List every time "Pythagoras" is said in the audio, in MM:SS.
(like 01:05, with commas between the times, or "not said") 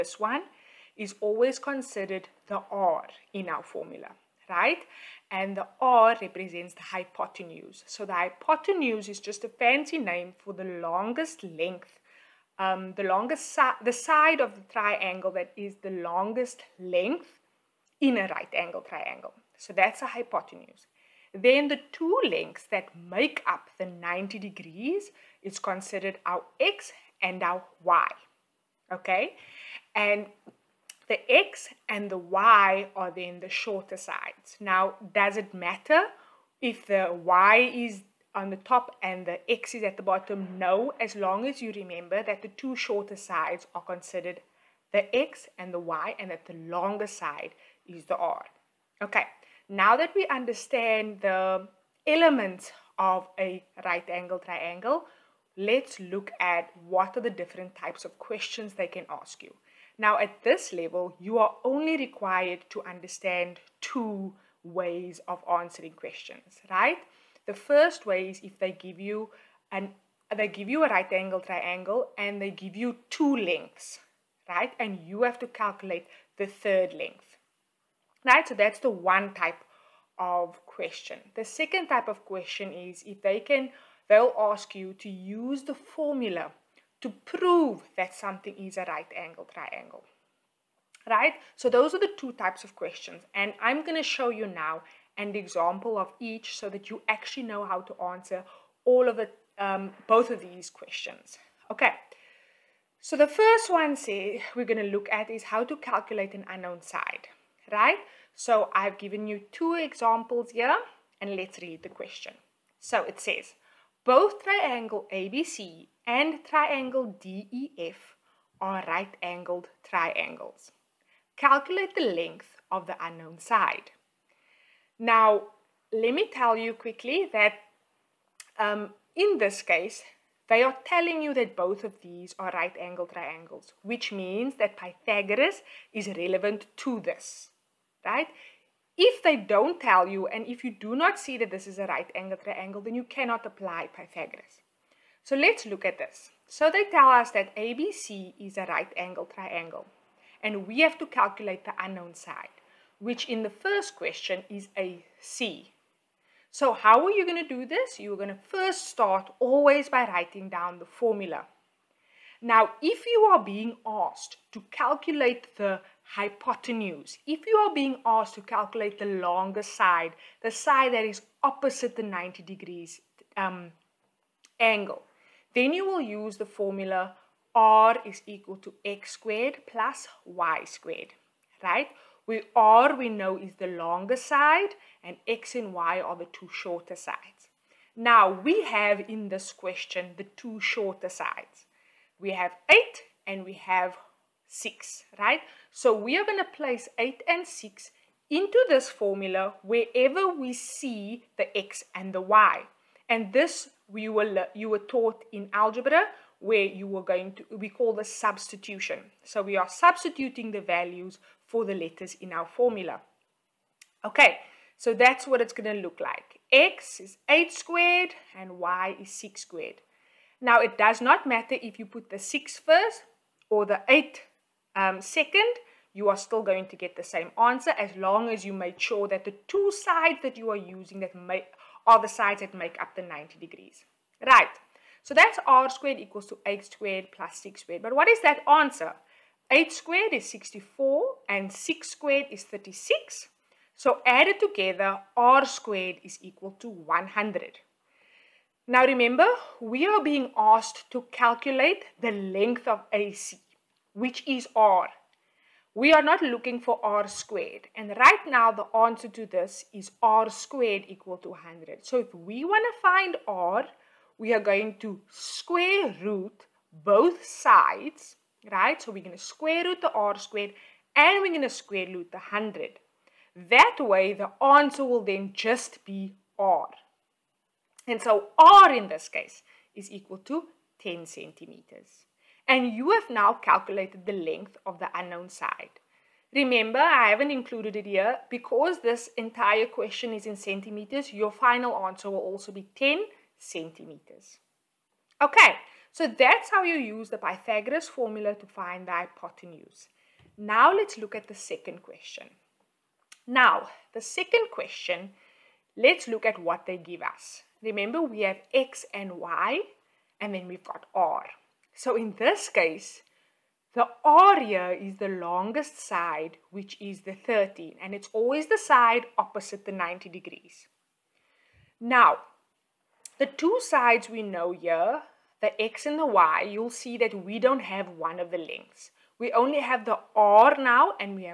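02:14, 02:23, 04:57.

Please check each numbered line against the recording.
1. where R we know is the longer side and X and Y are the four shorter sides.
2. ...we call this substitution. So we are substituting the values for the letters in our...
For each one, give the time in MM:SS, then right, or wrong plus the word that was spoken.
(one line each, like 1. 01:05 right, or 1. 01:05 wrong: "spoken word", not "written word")
1. 03:02 wrong: "two", not "four"
2. 03:27 right.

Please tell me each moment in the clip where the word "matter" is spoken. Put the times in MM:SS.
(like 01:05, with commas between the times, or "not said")
00:35, 03:41.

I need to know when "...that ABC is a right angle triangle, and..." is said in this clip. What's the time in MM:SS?
02:27.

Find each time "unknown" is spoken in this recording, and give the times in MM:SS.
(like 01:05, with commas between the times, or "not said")
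01:46, 02:03, 02:31, 04:44.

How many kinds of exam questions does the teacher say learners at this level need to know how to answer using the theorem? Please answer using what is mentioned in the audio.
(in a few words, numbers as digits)
2.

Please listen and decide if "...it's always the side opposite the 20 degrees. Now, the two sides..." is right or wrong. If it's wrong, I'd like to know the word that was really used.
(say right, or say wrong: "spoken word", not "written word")
wrong: "90", not "20".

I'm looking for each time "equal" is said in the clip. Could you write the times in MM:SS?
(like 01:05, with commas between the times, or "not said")
02:58, 03:55, 04:06, 04:20, 04:39.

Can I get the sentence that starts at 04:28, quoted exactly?
So we're going to square root the r squared and we're going to square root the 100.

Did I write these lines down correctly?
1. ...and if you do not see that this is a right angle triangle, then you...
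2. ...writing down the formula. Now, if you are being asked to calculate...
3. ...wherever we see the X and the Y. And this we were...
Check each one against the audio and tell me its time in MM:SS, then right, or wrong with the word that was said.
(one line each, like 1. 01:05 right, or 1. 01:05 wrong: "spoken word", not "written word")
1. 02:20 right
2. 02:40 right
3. 03:19 right.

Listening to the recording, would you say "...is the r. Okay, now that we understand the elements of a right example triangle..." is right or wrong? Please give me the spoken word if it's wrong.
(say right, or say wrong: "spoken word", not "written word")
wrong: "angle", not "example".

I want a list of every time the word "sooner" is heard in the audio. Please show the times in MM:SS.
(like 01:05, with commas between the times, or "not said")
not said.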